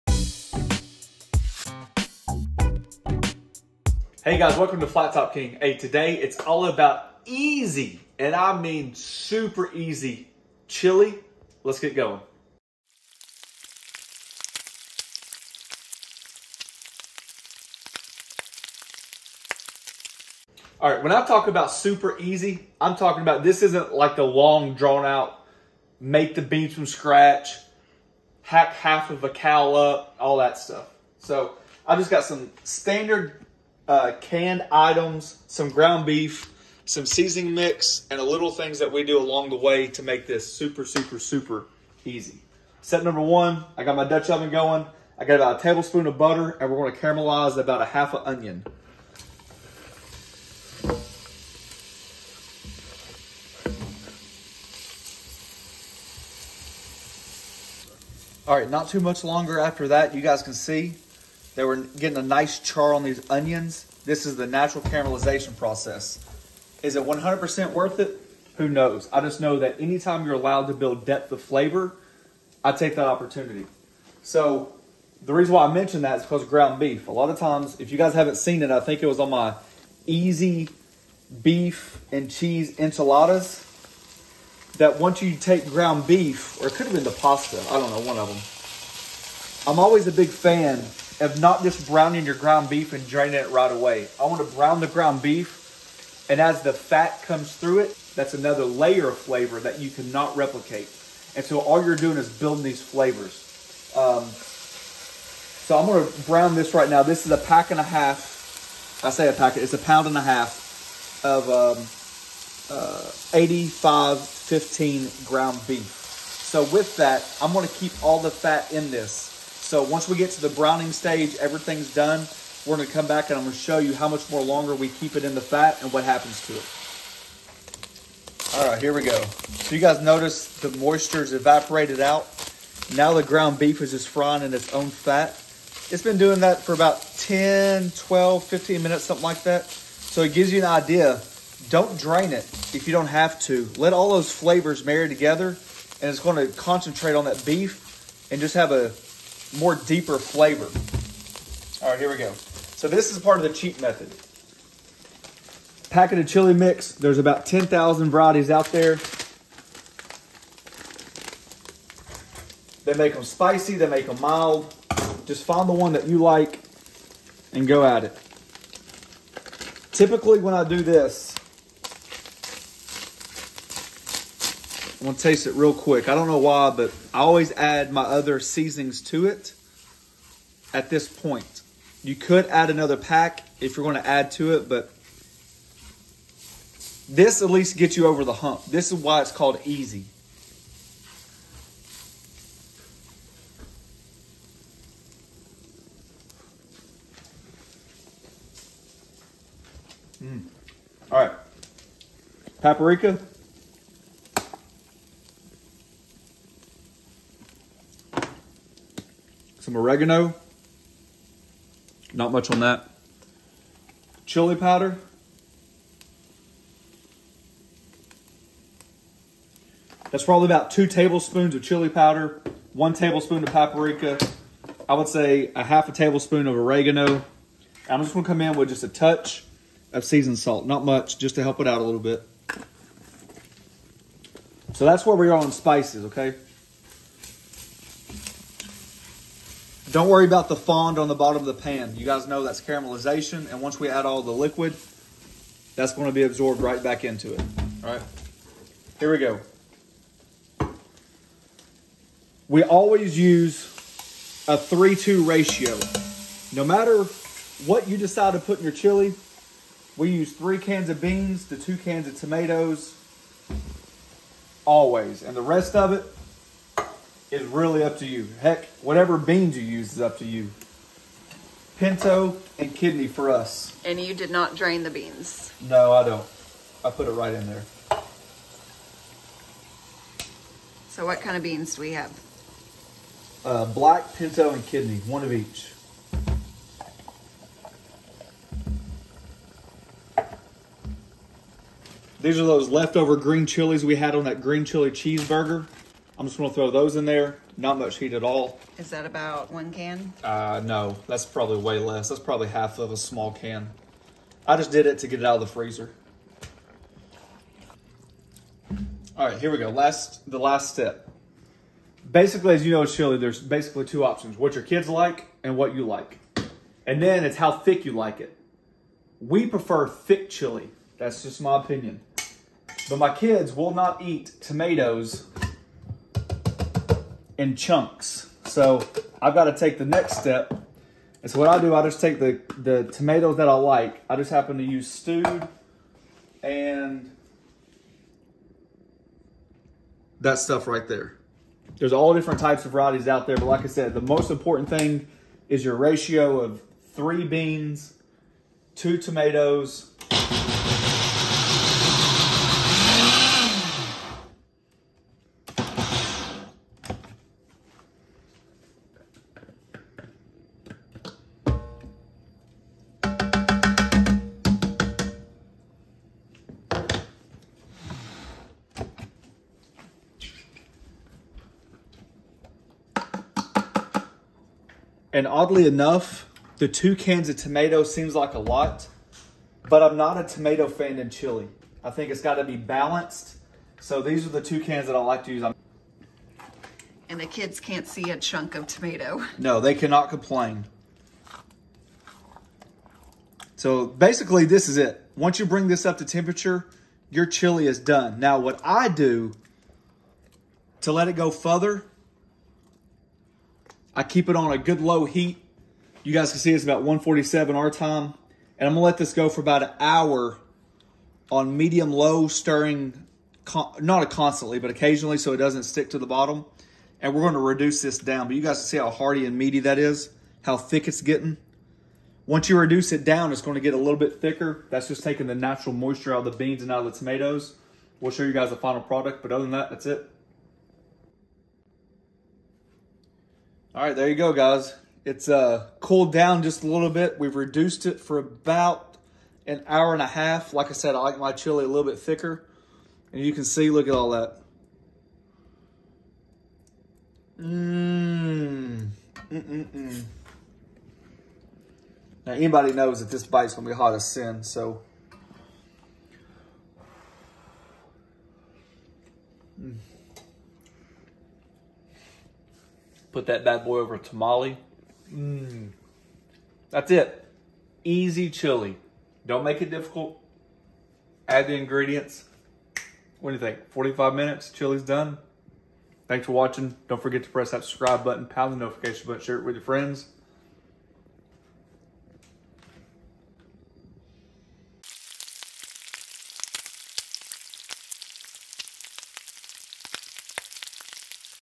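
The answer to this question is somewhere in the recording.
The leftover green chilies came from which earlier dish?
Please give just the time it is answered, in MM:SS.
04:54.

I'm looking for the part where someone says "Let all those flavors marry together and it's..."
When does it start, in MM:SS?
02:23.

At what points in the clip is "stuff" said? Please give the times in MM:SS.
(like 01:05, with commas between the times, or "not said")
00:30, 05:40.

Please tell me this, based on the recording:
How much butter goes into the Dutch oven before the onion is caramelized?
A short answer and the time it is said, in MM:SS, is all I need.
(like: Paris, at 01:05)
1 tablespoon, at 00:45.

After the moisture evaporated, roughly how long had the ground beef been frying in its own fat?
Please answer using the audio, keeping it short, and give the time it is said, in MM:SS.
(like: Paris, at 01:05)
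10 to 15 minutes, at 02:17.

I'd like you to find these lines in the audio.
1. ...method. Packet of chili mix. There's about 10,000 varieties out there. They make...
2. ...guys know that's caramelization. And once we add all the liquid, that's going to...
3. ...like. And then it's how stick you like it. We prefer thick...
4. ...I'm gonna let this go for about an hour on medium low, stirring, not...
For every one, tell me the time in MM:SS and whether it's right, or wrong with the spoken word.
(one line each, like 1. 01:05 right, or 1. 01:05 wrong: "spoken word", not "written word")
1. 02:33 right
2. 04:02 right
3. 05:15 wrong: "thick", not "stick"
4. 06:48 right.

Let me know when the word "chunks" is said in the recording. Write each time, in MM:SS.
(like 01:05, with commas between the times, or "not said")
05:27, 06:28.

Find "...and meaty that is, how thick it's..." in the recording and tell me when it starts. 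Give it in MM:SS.
06:59.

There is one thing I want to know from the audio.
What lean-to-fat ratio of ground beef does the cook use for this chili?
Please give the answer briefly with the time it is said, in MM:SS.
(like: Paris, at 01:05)
85/15, at 01:53.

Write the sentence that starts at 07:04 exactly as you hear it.
That's just taking the natural moisture out of the beans and out of the tomatoes.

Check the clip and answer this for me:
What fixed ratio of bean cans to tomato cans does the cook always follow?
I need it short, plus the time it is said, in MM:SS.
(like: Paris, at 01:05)
3-2, at 04:14.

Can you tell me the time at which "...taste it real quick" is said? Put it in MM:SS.
02:55.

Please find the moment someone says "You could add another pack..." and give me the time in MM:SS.
03:02.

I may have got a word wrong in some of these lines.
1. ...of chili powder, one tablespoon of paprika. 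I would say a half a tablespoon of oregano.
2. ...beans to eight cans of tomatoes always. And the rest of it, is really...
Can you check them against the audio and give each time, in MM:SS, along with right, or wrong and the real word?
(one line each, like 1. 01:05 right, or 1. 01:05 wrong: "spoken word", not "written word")
1. 03:41 right
2. 04:21 wrong: "two", not "eight".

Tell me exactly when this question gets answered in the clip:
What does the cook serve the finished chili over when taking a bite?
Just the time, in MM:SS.
07:43.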